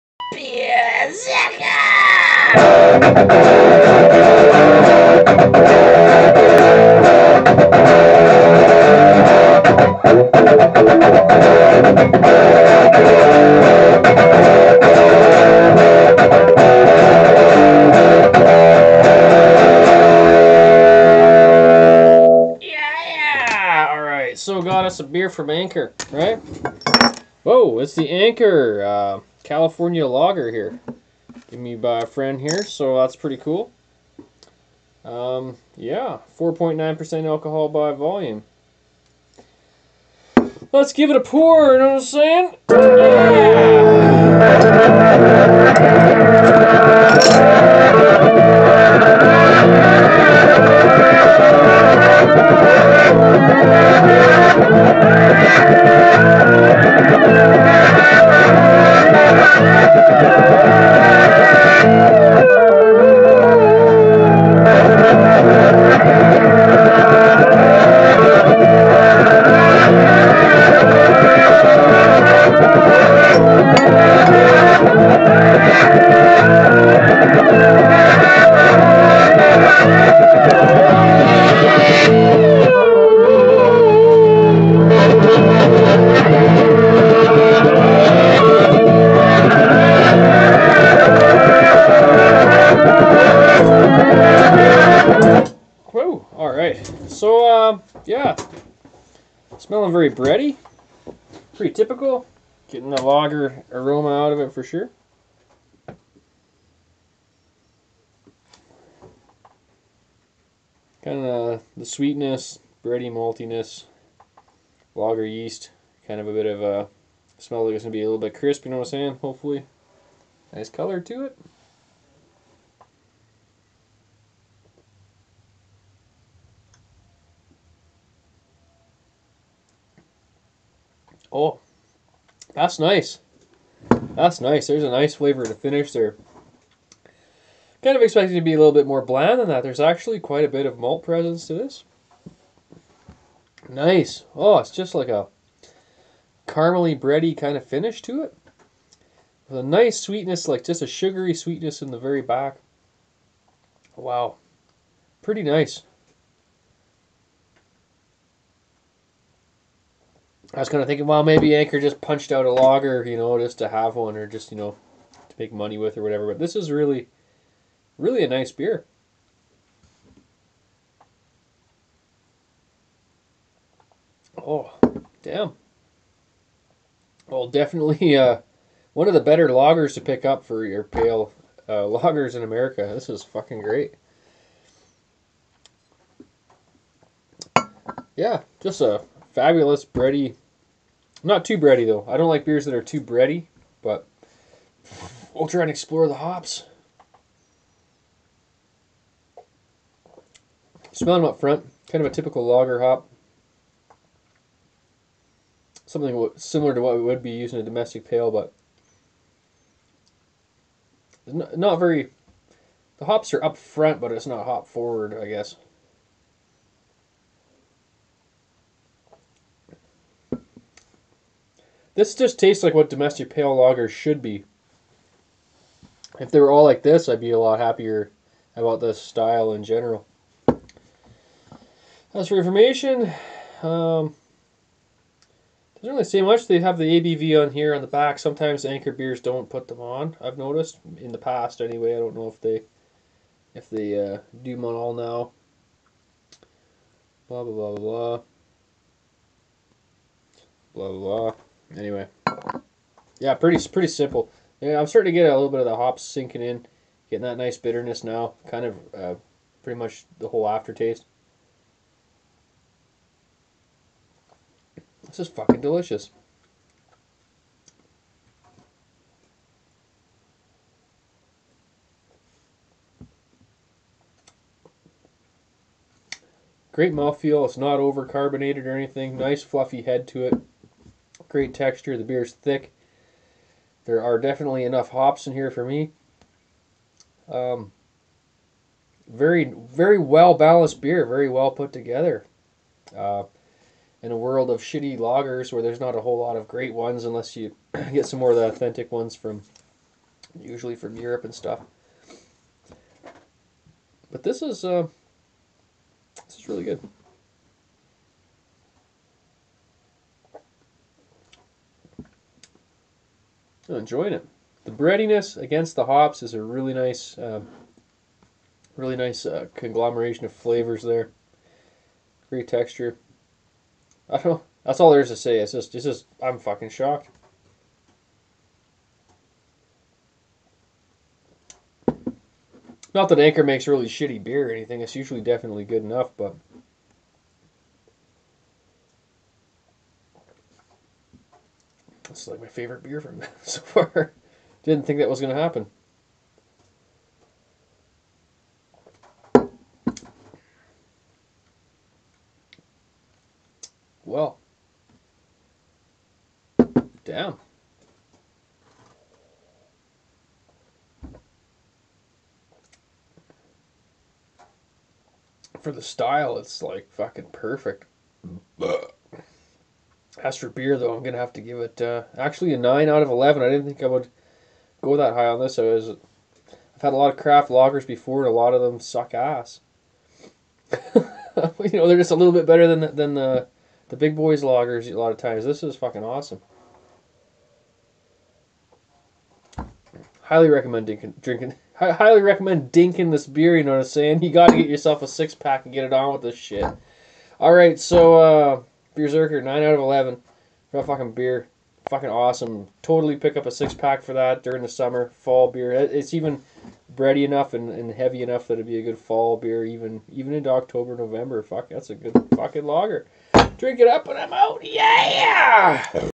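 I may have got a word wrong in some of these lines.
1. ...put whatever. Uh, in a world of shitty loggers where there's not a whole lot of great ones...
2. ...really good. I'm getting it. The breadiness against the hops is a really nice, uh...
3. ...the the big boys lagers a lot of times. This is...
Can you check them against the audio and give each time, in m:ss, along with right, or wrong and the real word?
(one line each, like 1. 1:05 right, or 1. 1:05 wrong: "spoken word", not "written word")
1. 4:51 wrong: "together", not "whatever"
2. 5:06 wrong: "enjoying", not "getting"
3. 6:23 right.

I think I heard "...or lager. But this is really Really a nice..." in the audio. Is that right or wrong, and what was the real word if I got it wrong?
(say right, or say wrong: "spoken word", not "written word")
wrong: "whatever", not "lager".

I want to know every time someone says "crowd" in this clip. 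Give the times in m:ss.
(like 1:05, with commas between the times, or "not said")
not said.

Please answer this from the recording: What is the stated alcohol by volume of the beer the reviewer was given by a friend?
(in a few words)
4.9%.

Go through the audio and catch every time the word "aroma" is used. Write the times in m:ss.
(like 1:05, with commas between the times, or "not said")
1:43.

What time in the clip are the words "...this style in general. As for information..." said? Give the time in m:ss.
3:48.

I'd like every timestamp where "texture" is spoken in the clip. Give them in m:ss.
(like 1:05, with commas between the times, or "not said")
4:41, 5:22.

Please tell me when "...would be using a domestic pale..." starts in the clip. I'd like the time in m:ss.
3:27.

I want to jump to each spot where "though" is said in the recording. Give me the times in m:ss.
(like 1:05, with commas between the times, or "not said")
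3:11, 6:10.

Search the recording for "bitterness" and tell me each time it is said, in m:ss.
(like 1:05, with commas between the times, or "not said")
4:17.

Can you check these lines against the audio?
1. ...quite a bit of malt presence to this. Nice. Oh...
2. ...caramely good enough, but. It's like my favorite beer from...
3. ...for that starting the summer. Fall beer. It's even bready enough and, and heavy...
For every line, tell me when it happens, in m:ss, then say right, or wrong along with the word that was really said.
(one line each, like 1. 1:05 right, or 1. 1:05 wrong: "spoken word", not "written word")
1. 2:20 right
2. 5:35 wrong: "definitely", not "caramely"
3. 6:44 wrong: "during", not "starting".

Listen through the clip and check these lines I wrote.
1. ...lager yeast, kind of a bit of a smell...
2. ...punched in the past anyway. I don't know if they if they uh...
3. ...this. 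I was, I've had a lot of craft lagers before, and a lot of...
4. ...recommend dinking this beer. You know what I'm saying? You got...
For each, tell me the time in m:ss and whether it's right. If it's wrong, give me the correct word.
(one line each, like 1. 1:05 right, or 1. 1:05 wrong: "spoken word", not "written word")
1. 1:54 right
2. 4:00 wrong: "noticed", not "punched"
3. 6:15 right
4. 6:32 right.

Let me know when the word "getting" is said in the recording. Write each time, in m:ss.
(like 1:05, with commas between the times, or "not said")
1:42, 4:17.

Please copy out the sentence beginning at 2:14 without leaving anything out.
There's a nice flavor to finish there.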